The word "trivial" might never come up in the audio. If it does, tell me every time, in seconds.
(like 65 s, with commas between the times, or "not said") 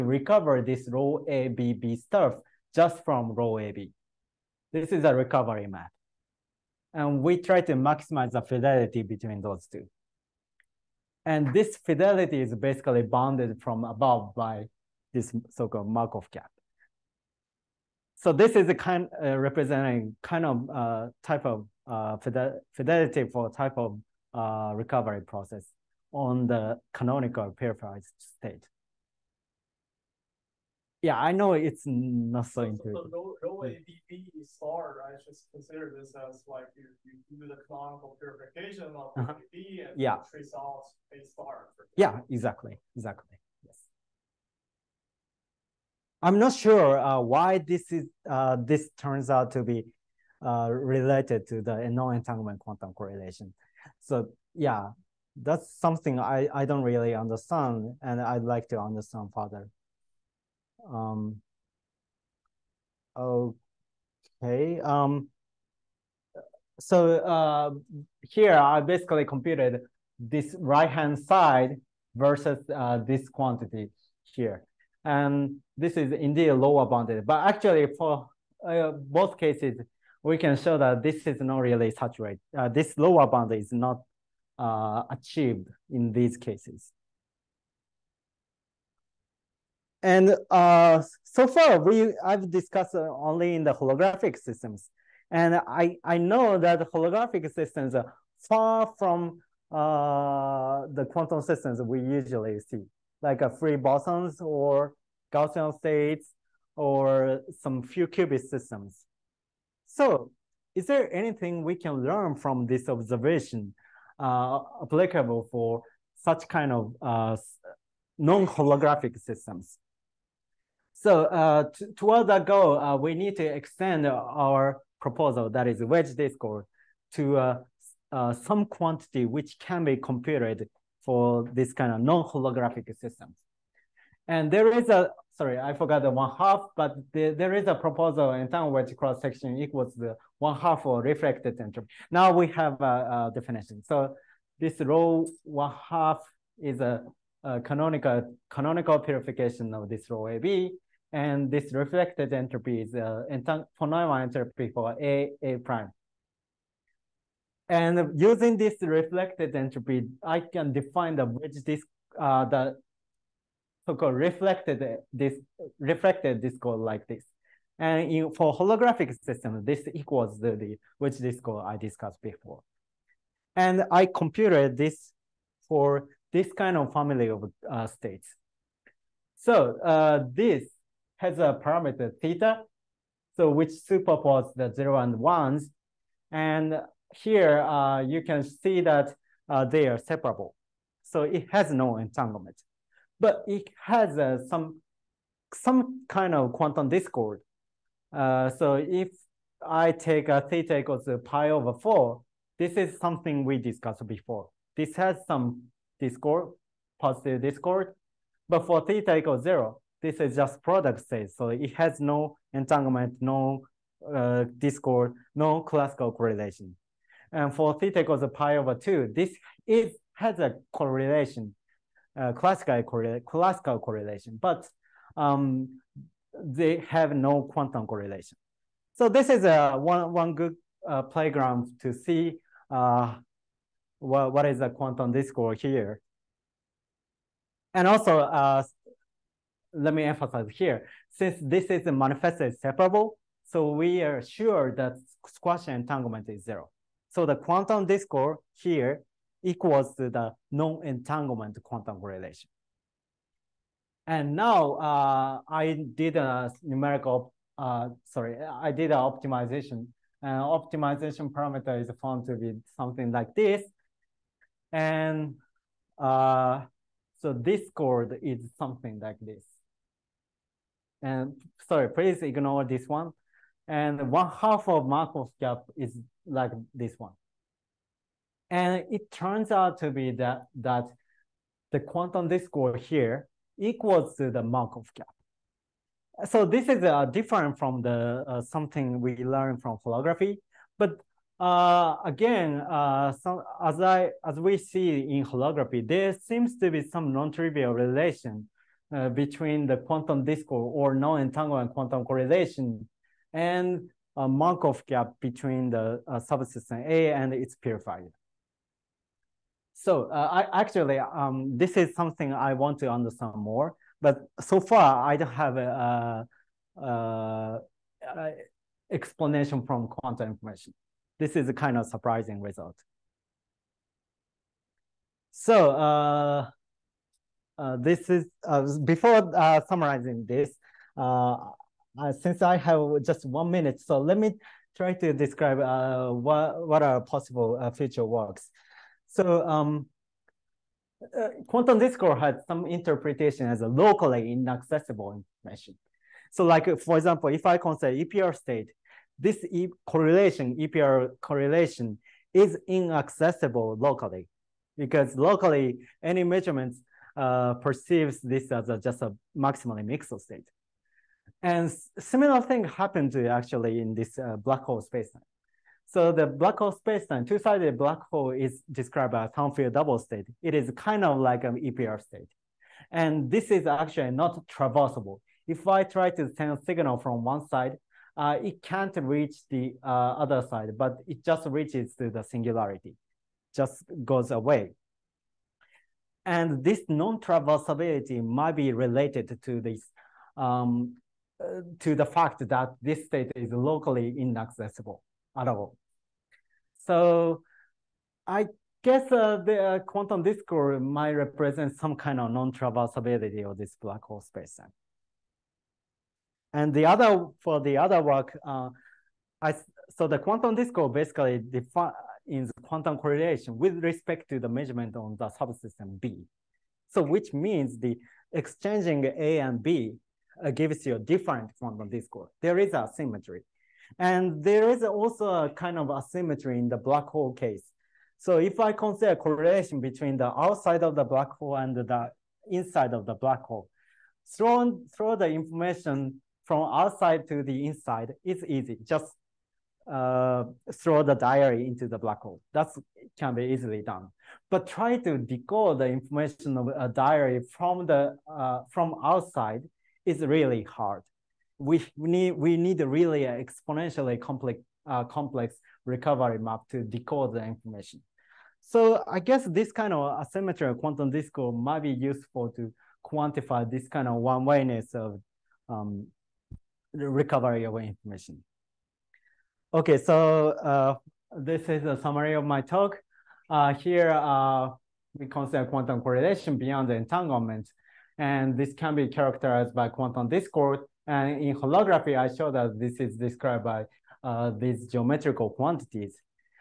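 297 s.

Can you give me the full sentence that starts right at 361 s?
And similar thing happened actually in this uh, black hole spacetime.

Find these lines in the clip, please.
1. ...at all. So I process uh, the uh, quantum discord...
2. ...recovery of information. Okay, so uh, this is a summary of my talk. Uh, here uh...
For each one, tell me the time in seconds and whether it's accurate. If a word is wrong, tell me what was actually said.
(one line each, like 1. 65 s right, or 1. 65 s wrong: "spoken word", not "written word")
1. 395 s wrong: "guess", not "process"
2. 466 s right.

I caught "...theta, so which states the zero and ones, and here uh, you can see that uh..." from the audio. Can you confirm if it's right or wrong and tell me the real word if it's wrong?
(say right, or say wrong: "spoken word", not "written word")
wrong: "superposes", not "states".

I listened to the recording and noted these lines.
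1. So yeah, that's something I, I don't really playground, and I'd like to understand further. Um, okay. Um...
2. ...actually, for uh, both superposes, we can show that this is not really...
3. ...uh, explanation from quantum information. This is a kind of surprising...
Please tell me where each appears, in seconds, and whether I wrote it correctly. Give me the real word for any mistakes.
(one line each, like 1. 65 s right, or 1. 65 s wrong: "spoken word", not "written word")
1. 53 s wrong: "understand", not "playground"
2. 77 s wrong: "cases", not "superposes"
3. 318 s right.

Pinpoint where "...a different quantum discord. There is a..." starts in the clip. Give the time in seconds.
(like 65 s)
420 s.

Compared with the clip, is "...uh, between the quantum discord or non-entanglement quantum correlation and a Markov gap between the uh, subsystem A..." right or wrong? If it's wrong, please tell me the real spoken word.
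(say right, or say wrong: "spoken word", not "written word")
right.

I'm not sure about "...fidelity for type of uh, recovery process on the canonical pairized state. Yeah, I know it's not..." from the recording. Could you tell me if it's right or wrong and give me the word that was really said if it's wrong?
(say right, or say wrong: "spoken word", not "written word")
right.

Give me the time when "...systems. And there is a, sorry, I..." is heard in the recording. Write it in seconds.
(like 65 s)
132 s.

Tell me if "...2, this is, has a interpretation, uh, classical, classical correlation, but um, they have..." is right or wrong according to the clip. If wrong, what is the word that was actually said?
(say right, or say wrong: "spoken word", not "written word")
wrong: "correlation", not "interpretation".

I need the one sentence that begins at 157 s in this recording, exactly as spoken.
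And using this reflected entropy, I can define the wedge disk, uh, the so-called reflected this reflected discord like this.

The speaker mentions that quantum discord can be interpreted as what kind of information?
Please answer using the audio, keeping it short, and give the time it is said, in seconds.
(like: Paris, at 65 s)
locally inaccessible information, at 343 s.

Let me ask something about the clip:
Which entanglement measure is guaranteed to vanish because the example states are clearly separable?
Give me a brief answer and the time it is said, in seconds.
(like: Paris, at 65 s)
squashed entanglement, at 245 s.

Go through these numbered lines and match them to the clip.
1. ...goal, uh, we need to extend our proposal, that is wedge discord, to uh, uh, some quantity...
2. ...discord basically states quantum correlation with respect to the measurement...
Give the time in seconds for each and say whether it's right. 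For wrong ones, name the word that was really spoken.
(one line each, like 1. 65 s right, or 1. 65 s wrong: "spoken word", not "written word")
1. 122 s right
2. 410 s wrong: "defines", not "states".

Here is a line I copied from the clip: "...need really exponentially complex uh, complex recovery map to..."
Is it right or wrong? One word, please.
right.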